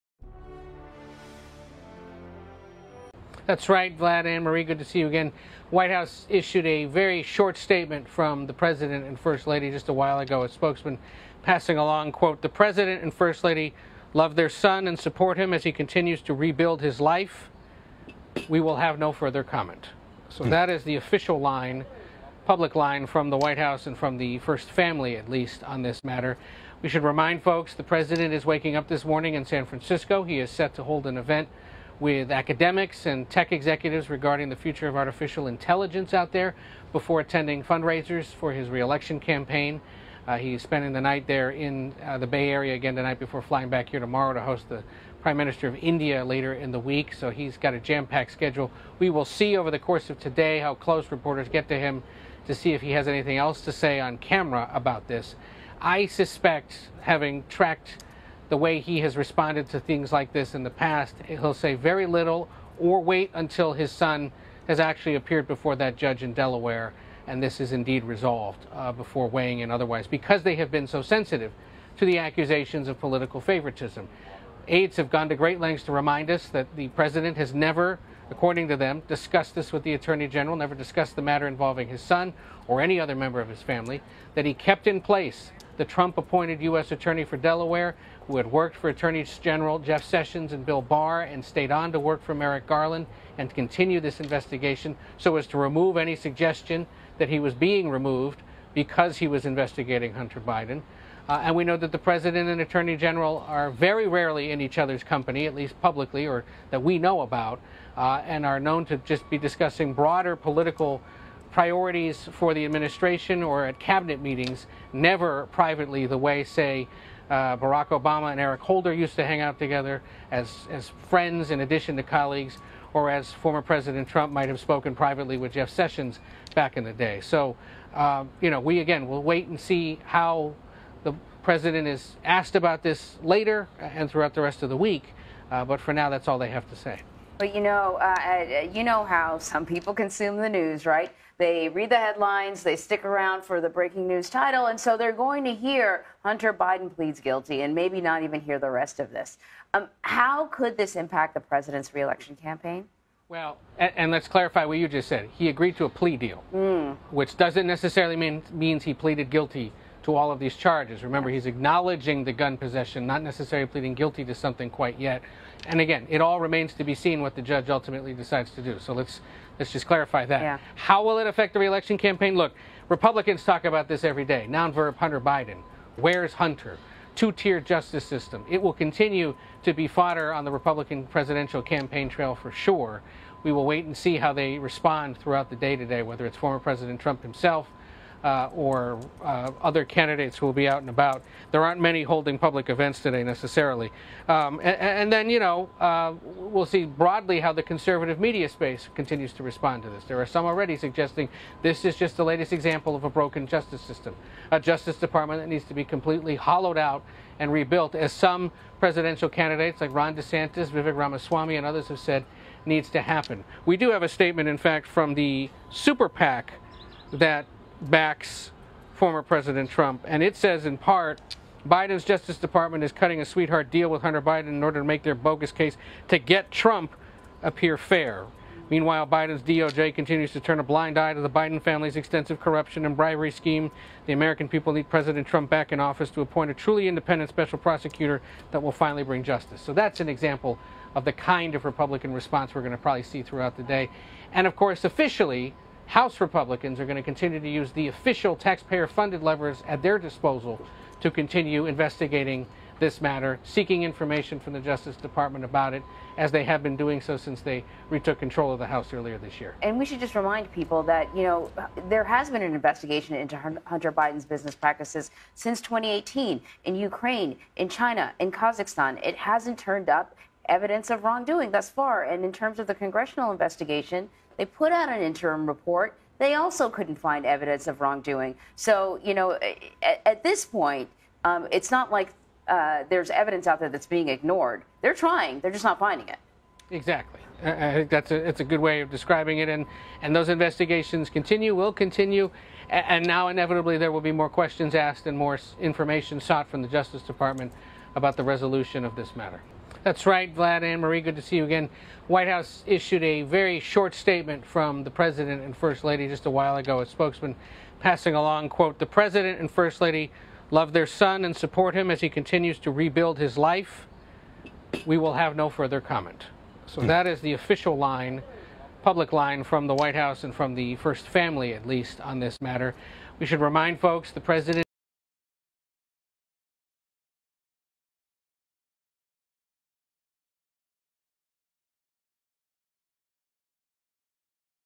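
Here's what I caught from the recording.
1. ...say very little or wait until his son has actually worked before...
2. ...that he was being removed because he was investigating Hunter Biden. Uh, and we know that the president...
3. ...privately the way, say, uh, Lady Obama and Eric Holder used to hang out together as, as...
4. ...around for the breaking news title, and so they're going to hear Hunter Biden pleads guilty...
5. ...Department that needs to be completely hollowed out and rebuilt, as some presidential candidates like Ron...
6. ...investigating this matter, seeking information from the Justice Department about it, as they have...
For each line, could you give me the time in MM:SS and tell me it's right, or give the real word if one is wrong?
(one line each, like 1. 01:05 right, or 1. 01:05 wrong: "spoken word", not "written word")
1. 01:01 wrong: "appeared", not "worked"
2. 01:37 right
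3. 01:55 wrong: "Barack", not "Lady"
4. 02:23 right
5. 03:24 right
6. 04:11 right.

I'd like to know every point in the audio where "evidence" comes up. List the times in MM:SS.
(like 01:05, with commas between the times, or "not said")
04:30, 04:37, 04:43.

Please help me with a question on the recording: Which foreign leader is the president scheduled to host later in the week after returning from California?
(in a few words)
Prime Minister of India.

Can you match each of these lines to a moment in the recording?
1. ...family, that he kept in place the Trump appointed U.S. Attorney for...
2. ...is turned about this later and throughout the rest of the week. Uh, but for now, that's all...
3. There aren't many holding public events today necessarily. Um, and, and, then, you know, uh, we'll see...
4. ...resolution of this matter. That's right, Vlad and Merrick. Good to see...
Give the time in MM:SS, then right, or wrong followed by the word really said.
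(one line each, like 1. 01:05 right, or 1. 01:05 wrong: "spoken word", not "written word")
1. 01:23 right
2. 02:11 wrong: "asked", not "turned"
3. 03:11 right
4. 04:58 wrong: "Marie", not "Merrick".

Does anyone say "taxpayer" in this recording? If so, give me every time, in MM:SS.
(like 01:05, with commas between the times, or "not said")
04:08.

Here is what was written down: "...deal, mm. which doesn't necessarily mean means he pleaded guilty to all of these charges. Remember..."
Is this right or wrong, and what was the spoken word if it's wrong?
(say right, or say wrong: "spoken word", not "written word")
right.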